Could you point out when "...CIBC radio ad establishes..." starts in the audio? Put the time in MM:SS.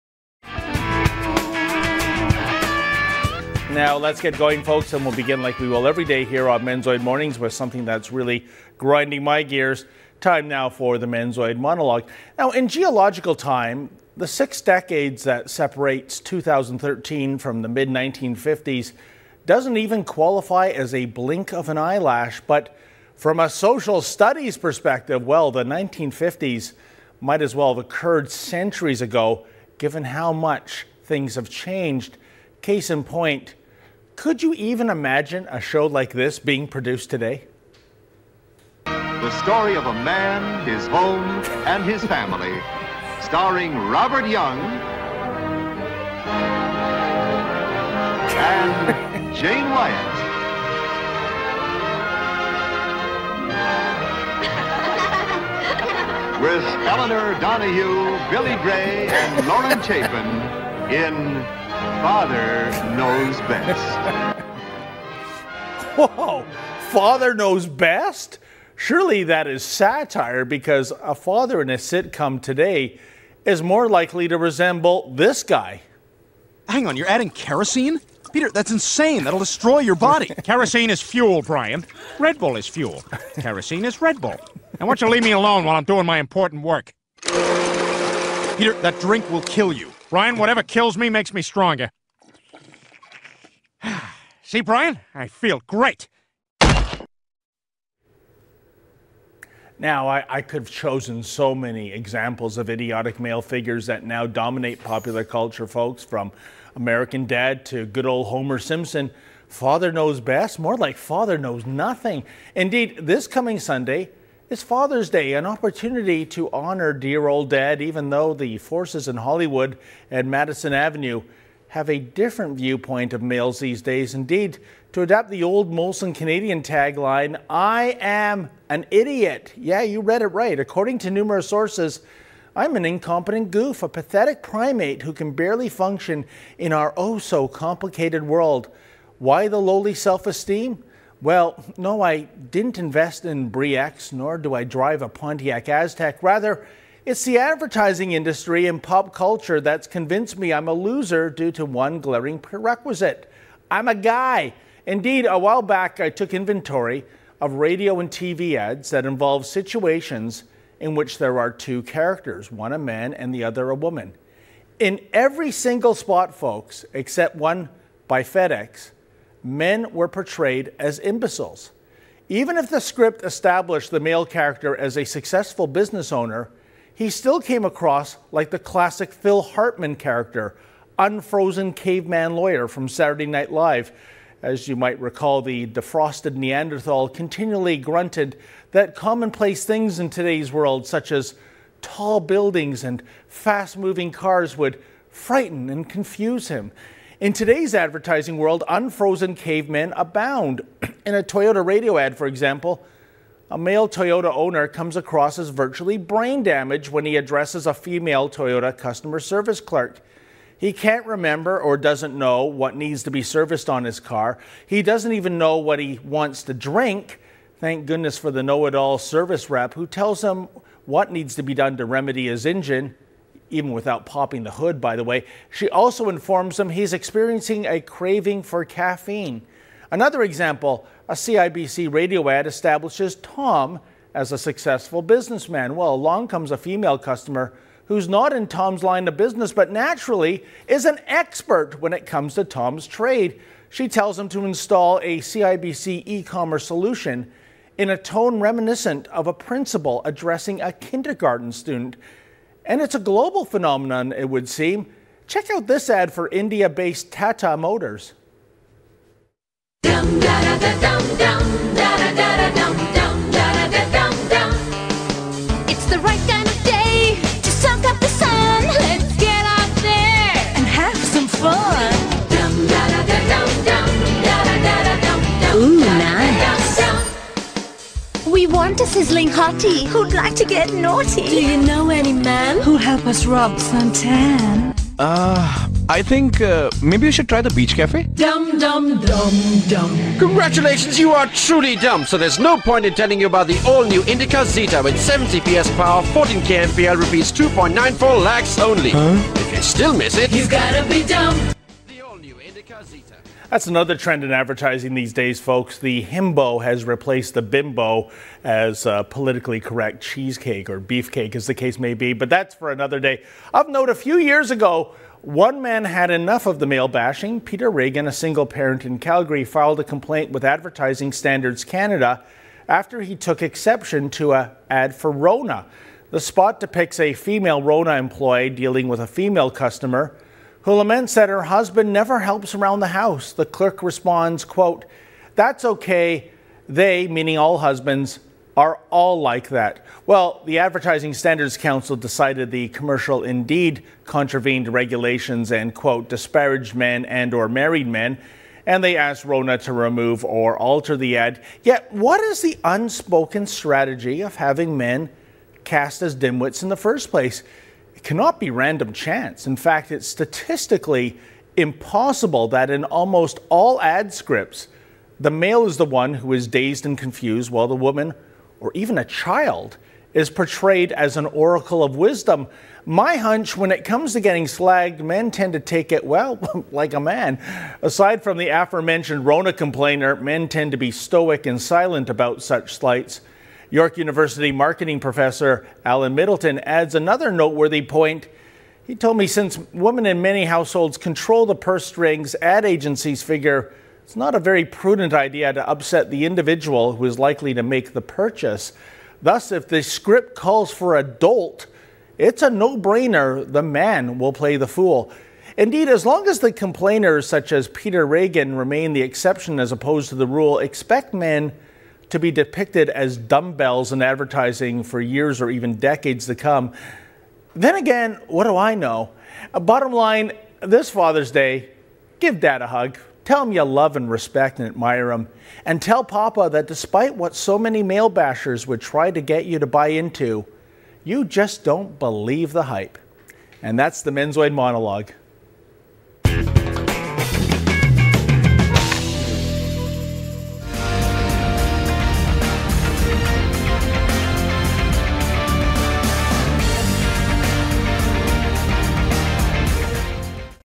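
03:51.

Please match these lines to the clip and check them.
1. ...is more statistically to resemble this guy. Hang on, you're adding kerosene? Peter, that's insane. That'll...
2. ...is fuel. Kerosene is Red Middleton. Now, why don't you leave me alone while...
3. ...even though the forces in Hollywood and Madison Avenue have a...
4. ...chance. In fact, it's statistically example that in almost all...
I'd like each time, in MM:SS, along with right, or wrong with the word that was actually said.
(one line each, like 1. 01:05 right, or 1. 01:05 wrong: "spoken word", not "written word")
1. 01:13 wrong: "likely", not "statistically"
2. 01:22 wrong: "Bull", not "Middleton"
3. 01:57 right
4. 05:58 wrong: "impossible", not "example".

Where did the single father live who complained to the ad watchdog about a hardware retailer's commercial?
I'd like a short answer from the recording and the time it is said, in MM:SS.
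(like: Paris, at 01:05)
Calgary, at 05:18.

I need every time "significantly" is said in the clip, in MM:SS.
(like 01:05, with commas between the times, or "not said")
not said.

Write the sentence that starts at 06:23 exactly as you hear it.
York University marketing professor Alan Middleton adds another noteworthy point.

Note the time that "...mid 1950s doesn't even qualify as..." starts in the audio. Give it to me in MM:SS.
00:17.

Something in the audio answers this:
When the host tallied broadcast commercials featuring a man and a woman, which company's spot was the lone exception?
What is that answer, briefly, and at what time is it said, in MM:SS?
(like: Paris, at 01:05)
FedEx, at 02:48.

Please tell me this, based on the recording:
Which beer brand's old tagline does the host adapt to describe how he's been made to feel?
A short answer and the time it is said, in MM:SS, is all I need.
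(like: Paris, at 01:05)
Molson Canadian, at 02:05.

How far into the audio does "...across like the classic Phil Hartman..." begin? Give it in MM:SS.
02:57.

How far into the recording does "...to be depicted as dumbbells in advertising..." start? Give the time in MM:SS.
06:52.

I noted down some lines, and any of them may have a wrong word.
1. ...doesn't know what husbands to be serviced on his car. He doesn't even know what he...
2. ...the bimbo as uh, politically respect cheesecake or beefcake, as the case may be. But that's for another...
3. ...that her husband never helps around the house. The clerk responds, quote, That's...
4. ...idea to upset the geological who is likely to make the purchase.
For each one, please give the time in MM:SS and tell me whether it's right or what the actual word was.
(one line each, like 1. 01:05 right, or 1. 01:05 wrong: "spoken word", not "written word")
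1. 03:31 wrong: "needs", not "husbands"
2. 05:07 wrong: "correct", not "respect"
3. 05:31 right
4. 06:35 wrong: "individual", not "geological".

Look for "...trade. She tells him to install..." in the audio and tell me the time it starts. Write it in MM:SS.
04:02.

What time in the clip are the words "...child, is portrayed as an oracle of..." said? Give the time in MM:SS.
06:09.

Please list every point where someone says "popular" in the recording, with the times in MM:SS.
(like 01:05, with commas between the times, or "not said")
01:44.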